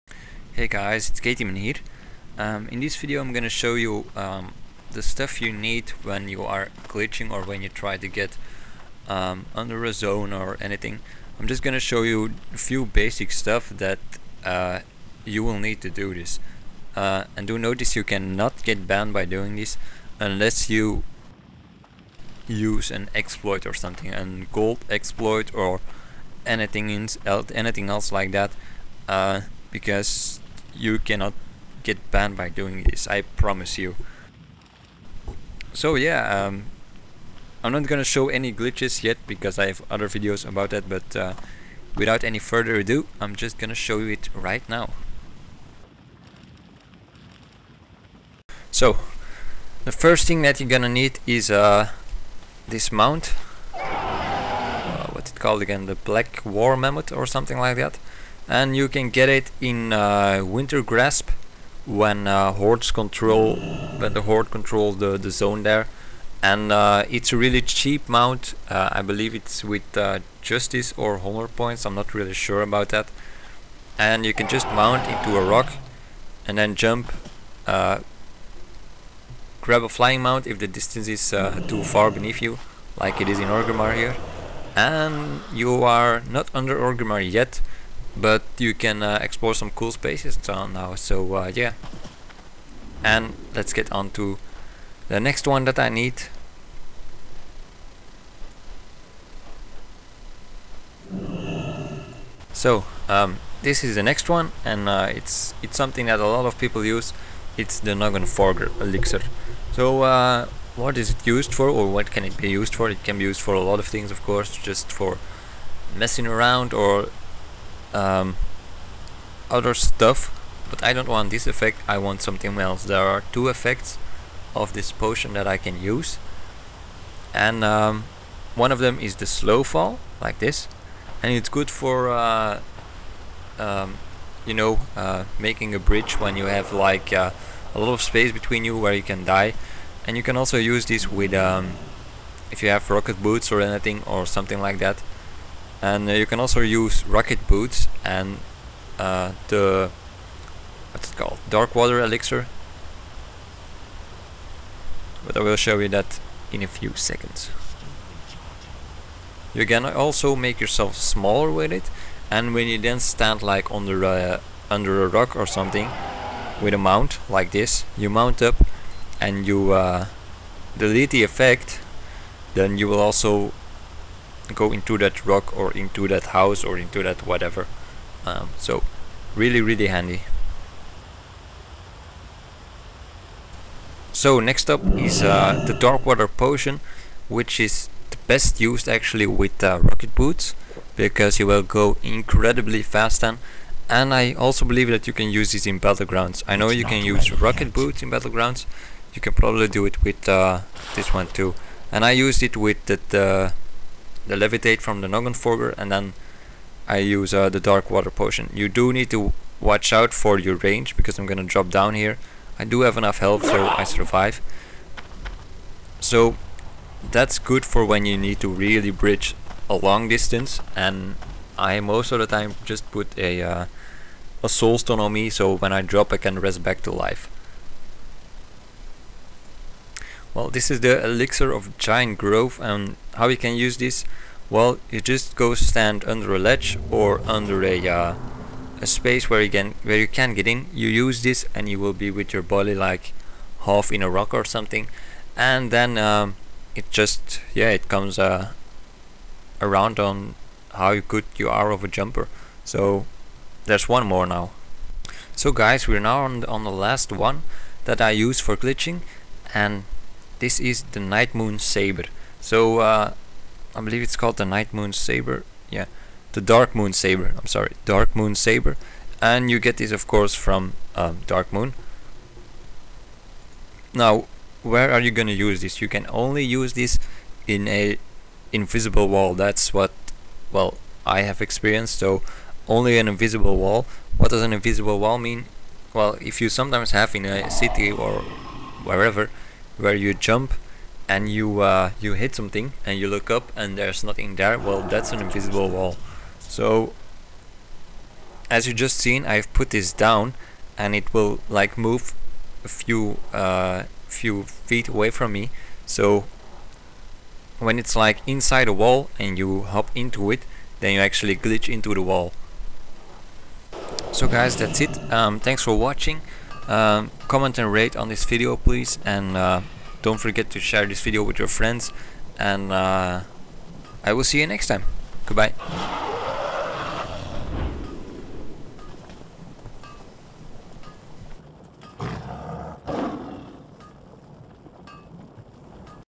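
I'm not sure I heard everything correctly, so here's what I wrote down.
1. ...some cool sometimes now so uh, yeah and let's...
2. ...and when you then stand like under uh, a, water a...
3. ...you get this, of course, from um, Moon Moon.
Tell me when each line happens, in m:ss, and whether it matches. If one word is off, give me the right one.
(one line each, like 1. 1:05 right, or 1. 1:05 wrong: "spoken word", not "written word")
1. 1:29 wrong: "spaces", not "sometimes"
2. 2:42 wrong: "under", not "water"
3. 4:29 wrong: "Dark", not "Moon".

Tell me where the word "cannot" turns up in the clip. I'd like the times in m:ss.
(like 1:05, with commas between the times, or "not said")
0:18, 0:30.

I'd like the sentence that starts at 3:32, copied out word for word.
I do have enough health, so I survive.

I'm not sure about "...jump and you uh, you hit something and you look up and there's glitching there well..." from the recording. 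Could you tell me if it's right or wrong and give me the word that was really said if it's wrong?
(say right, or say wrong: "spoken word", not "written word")
wrong: "nothing", not "glitching".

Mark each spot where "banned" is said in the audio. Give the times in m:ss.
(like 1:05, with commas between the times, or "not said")
0:18, 0:32.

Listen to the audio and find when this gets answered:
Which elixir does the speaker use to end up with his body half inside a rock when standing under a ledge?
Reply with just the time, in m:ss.
3:51.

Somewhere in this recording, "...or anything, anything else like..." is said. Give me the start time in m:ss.
0:25.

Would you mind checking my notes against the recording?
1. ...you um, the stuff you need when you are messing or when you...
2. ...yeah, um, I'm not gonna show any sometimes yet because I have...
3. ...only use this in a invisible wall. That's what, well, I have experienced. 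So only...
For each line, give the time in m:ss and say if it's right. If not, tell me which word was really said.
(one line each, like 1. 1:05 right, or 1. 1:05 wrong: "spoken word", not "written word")
1. 0:03 wrong: "glitching", not "messing"
2. 0:35 wrong: "glitches", not "sometimes"
3. 4:36 right.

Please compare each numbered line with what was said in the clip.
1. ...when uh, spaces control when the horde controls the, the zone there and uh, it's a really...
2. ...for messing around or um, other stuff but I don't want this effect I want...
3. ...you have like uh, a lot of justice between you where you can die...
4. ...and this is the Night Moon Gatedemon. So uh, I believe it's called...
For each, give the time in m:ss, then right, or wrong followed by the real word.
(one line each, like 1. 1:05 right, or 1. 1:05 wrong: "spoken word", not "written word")
1. 1:01 wrong: "hordes", not "spaces"
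2. 1:54 right
3. 2:16 wrong: "space", not "justice"
4. 4:19 wrong: "Saber", not "Gatedemon".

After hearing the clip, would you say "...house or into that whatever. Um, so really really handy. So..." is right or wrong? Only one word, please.
right.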